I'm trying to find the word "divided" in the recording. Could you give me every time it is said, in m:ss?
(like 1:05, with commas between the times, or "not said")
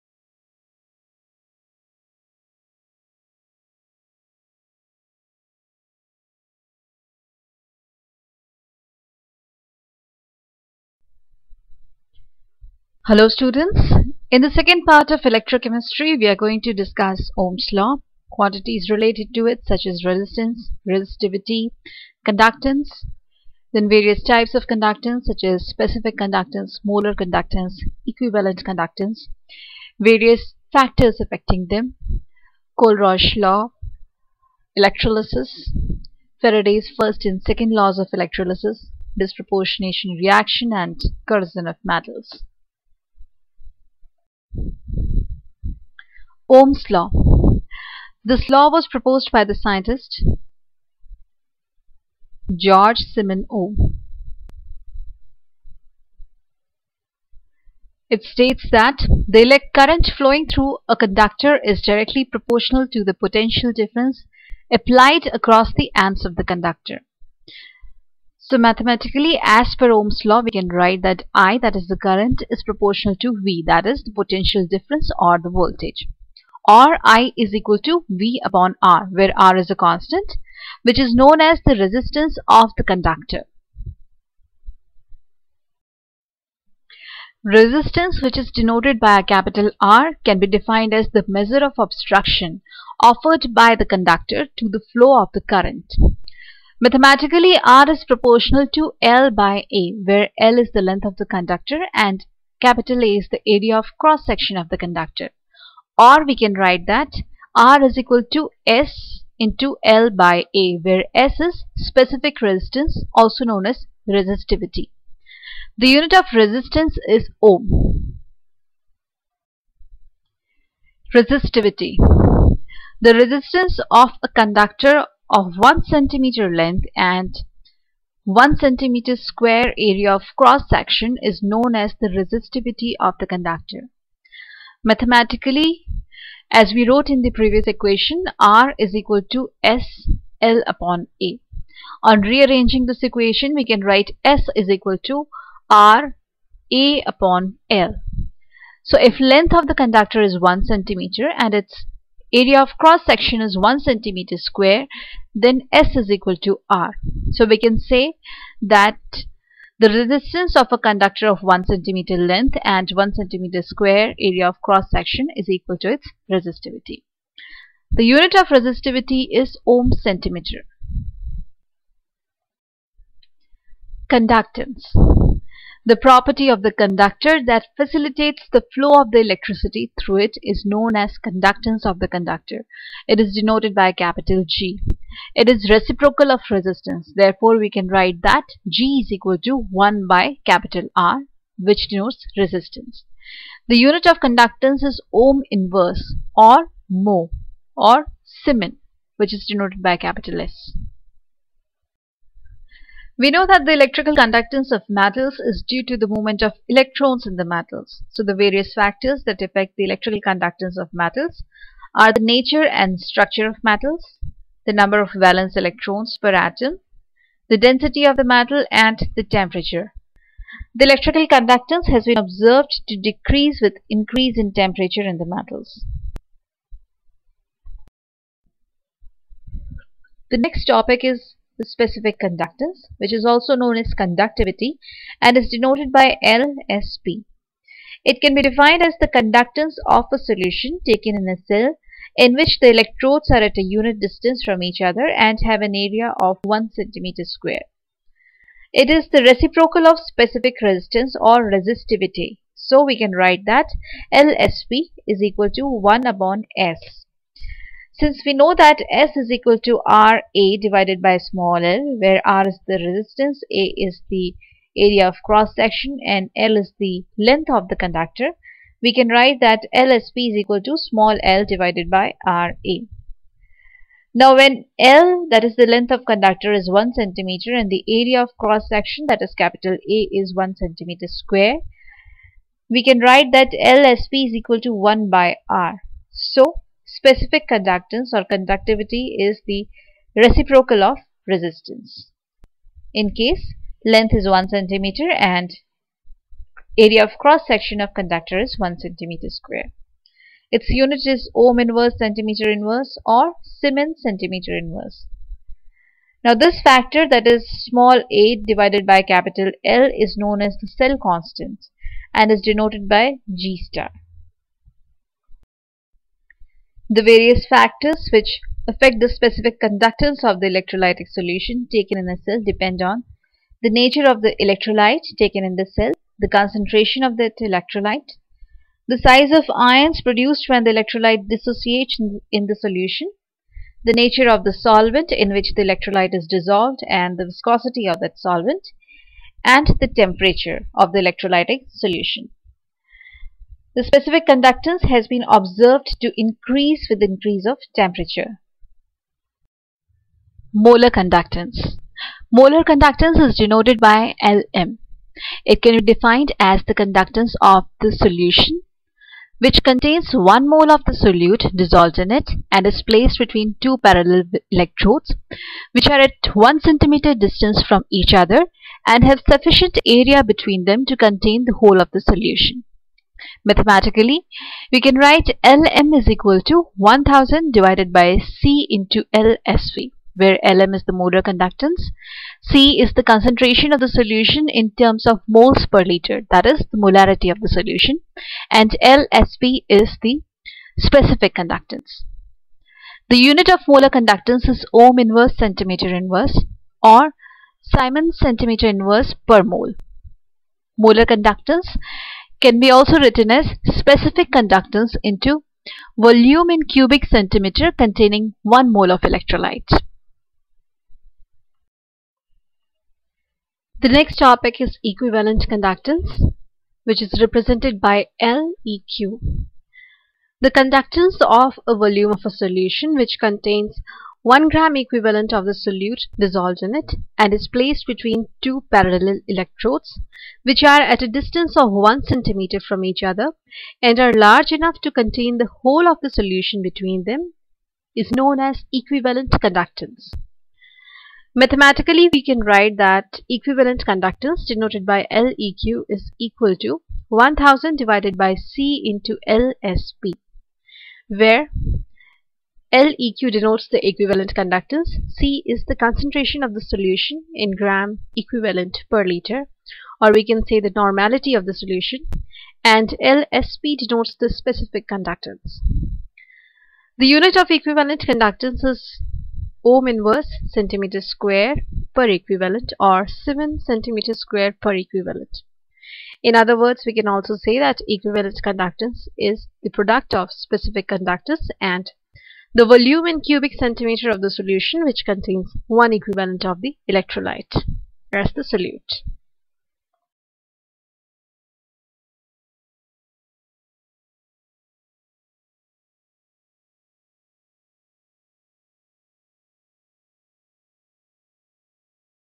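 4:20, 4:31, 5:08, 6:17, 7:27.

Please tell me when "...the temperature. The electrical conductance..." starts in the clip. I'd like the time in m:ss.
3:39.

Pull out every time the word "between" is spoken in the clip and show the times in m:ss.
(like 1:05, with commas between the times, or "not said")
6:03, 6:10, 7:07, 7:16.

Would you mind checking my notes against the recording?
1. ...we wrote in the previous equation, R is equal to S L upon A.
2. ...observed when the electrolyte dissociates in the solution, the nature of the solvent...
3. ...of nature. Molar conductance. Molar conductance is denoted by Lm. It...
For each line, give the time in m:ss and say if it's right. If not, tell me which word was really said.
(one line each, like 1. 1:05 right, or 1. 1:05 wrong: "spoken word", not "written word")
1. 2:16 right
2. 5:30 wrong: "produced", not "observed"
3. 5:47 wrong: "temperature", not "nature".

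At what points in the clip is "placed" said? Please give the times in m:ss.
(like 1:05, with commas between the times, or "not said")
6:02, 7:07.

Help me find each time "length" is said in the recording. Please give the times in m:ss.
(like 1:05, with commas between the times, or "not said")
1:40, 2:06, 2:29, 2:42, 4:27, 4:35, 4:53.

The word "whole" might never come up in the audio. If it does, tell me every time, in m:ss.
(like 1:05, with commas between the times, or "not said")
6:11, 7:15.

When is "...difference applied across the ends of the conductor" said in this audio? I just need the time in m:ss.
1:03.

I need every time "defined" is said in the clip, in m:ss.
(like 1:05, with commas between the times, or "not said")
1:30, 3:58, 5:55.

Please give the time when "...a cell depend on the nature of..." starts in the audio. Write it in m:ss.
5:22.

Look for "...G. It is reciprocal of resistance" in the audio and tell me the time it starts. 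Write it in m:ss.
3:04.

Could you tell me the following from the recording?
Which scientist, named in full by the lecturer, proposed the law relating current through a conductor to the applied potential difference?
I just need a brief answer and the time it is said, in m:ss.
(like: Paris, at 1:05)
George Simon Ohm, at 0:52.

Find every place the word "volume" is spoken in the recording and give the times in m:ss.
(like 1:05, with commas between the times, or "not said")
6:45, 7:01, 8:02.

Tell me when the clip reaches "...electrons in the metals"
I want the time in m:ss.
3:26.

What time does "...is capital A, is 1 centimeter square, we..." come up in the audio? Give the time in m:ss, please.
4:39.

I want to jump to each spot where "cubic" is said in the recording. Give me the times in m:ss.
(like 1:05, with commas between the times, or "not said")
6:46, 8:03.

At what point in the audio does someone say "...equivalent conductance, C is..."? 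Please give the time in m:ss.
7:33.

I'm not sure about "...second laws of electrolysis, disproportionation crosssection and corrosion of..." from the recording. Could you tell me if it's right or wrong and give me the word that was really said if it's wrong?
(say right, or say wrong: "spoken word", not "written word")
wrong: "reaction", not "crosssection".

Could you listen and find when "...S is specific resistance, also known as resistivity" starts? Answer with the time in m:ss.
1:51.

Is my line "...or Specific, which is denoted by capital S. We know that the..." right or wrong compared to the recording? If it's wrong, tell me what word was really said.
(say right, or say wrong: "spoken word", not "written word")
wrong: "Siemens", not "Specific".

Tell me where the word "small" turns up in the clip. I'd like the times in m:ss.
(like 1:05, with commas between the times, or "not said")
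4:21, 4:30, 5:07.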